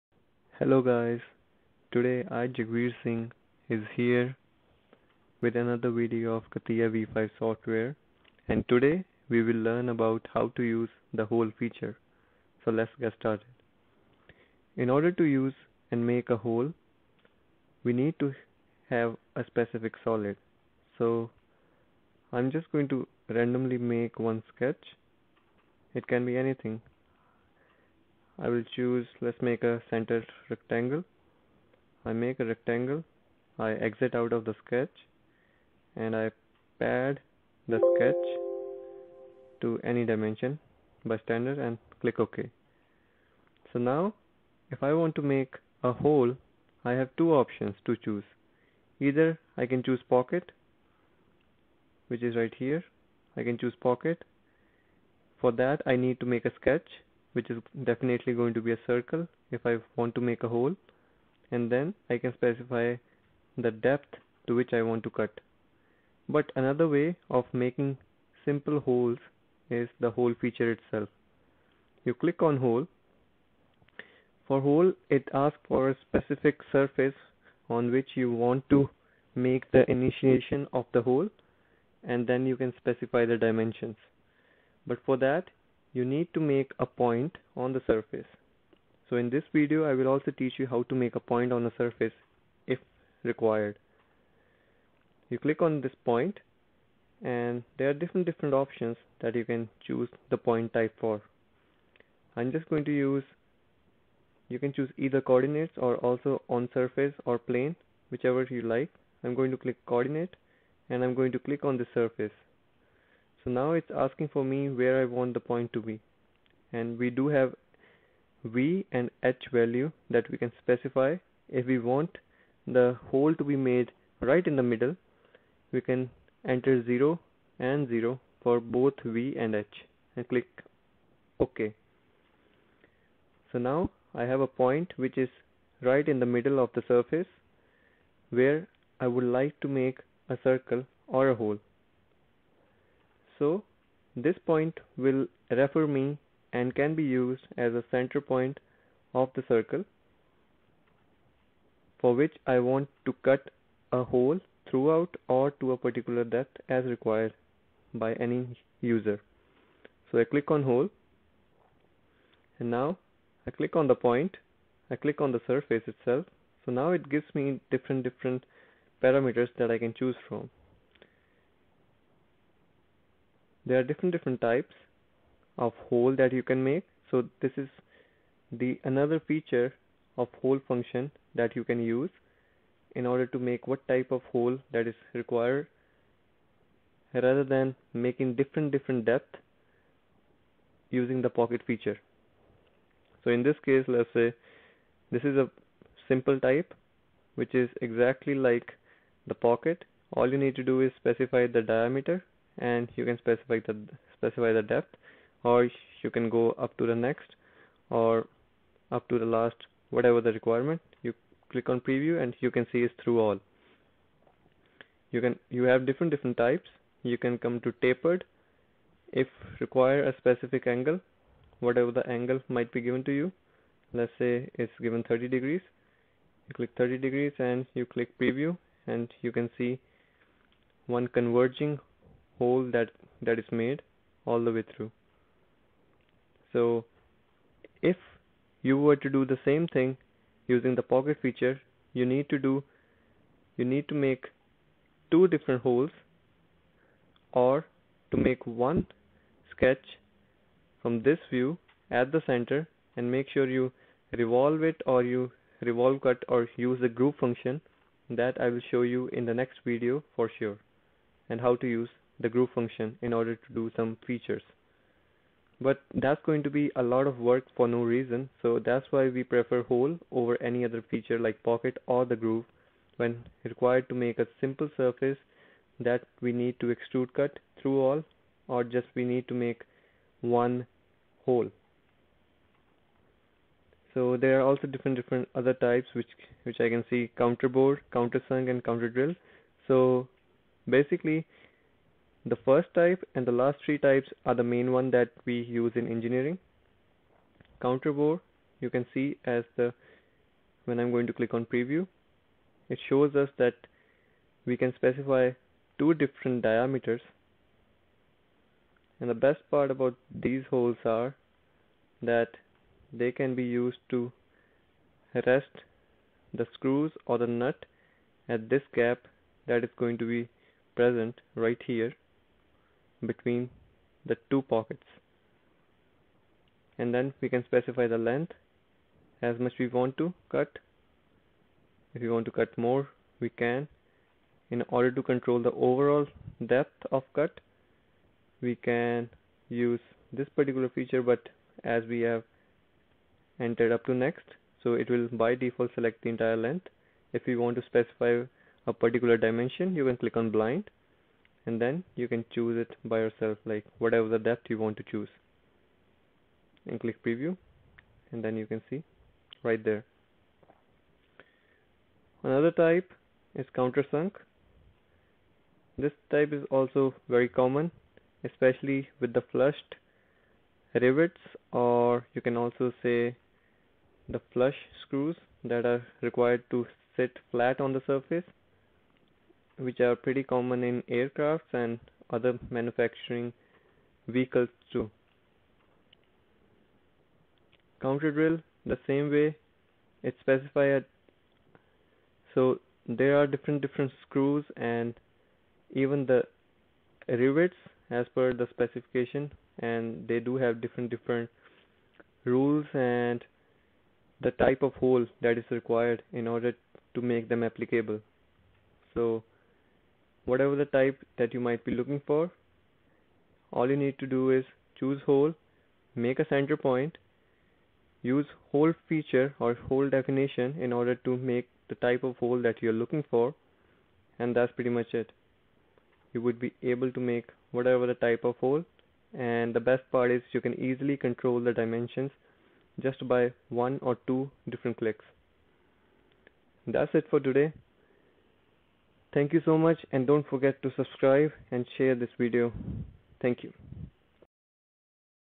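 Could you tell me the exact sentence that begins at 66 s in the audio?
But another way of making simple holes is the hole feature itself.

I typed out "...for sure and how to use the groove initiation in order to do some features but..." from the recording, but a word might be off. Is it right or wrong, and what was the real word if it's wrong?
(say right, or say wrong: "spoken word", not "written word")
wrong: "function", not "initiation".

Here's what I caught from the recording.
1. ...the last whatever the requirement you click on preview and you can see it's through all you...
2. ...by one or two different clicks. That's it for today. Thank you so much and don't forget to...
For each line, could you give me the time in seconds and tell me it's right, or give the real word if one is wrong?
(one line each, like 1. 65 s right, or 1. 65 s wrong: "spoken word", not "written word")
1. 209 s right
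2. 433 s right.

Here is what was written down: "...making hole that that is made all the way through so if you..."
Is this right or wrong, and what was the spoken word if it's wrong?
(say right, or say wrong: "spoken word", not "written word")
wrong: "converging", not "making".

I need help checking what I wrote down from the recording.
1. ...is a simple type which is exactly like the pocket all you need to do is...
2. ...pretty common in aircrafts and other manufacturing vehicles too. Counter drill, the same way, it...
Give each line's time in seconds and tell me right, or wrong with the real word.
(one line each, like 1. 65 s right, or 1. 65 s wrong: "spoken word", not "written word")
1. 195 s right
2. 379 s right.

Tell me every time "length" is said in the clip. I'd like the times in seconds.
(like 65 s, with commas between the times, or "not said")
327 s, 346 s.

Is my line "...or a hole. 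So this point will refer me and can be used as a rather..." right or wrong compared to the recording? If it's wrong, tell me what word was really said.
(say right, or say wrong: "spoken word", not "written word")
wrong: "center", not "rather".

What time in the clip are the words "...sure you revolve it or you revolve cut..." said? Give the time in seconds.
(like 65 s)
253 s.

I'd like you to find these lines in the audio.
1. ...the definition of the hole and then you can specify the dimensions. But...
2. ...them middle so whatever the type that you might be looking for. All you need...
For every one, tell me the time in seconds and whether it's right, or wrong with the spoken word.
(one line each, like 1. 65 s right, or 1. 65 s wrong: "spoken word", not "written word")
1. 79 s wrong: "initiation", not "definition"
2. 407 s wrong: "applicable", not "middle".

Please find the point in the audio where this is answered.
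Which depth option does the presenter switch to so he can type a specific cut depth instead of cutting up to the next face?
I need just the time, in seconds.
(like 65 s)
350 s.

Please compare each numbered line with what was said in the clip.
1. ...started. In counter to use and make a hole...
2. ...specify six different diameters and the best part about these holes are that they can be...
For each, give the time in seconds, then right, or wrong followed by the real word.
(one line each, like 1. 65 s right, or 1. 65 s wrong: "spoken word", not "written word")
1. 13 s wrong: "order", not "counter"
2. 304 s wrong: "two", not "six".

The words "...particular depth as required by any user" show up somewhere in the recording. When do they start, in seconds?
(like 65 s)
155 s.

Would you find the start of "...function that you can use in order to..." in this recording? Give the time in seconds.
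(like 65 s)
180 s.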